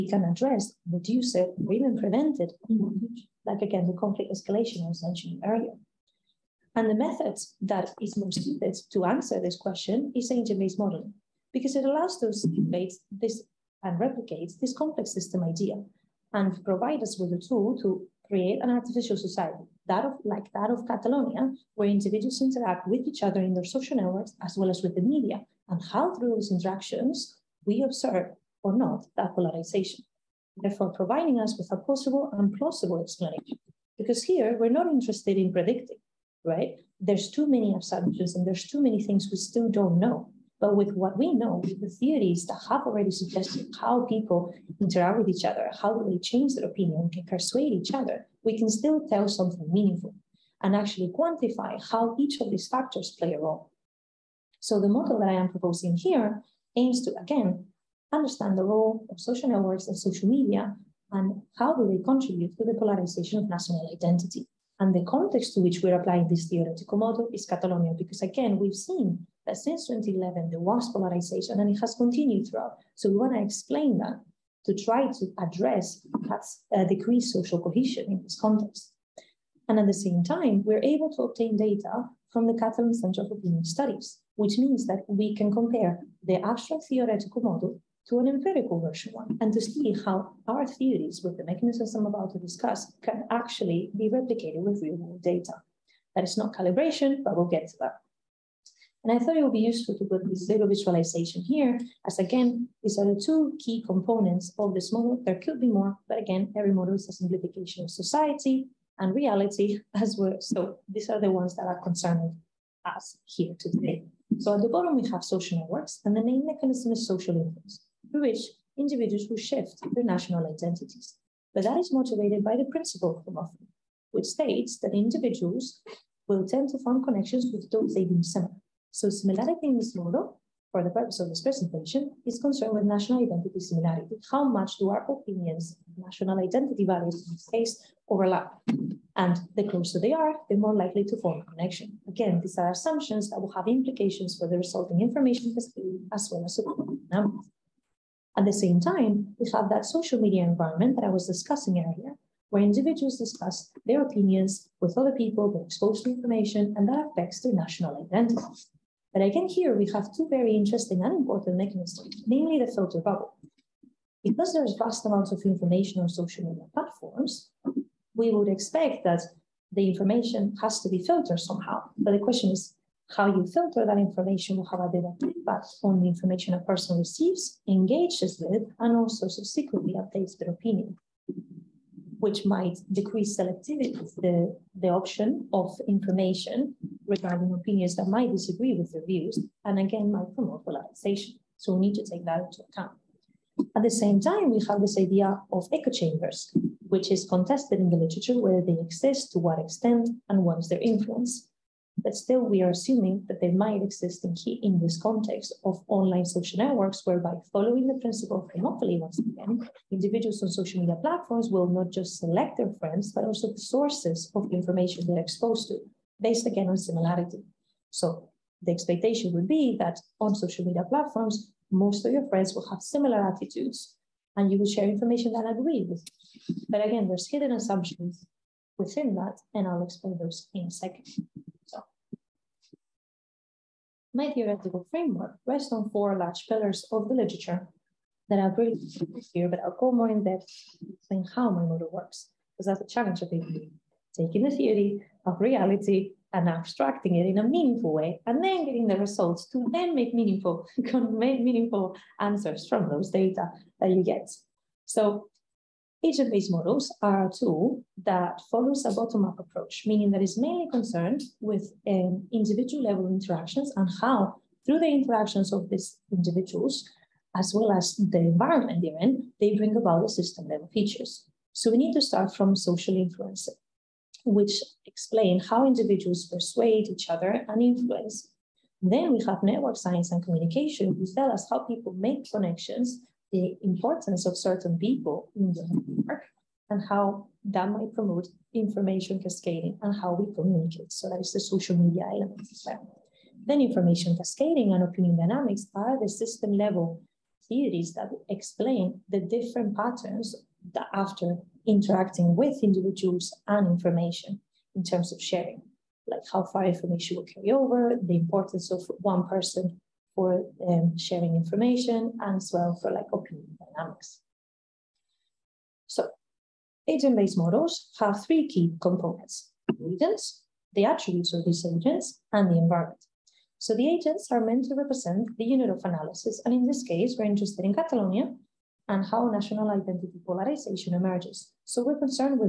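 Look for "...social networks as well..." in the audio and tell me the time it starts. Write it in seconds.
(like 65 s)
23 s.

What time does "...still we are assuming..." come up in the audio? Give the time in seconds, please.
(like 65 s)
202 s.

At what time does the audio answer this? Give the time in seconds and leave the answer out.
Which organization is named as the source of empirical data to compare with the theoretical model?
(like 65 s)
82 s.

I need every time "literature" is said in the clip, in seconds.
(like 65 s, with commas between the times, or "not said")
197 s, 237 s.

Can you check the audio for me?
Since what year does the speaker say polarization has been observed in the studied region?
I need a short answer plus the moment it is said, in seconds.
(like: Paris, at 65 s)
2011, at 69 s.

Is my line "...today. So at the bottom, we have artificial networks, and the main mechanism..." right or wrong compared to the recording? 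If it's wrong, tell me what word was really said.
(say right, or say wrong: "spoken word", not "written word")
wrong: "social", not "artificial".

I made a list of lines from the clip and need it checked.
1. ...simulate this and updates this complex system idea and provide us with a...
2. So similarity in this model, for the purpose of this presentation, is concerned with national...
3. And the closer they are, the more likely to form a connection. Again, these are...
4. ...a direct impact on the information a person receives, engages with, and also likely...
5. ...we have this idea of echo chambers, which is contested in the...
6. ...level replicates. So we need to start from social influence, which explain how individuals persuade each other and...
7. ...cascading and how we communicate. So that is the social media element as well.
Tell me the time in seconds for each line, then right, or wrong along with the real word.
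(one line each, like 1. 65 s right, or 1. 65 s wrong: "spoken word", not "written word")
1. 12 s wrong: "replicates", not "updates"
2. 128 s right
3. 139 s right
4. 174 s wrong: "subsequently", not "likely"
5. 194 s right
6. 270 s wrong: "features", not "replicates"
7. 289 s right.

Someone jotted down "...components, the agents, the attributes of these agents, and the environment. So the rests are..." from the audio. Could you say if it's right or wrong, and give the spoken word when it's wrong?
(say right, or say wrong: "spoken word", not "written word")
wrong: "agents", not "rests".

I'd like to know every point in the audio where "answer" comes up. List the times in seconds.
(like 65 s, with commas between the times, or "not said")
9 s, 252 s.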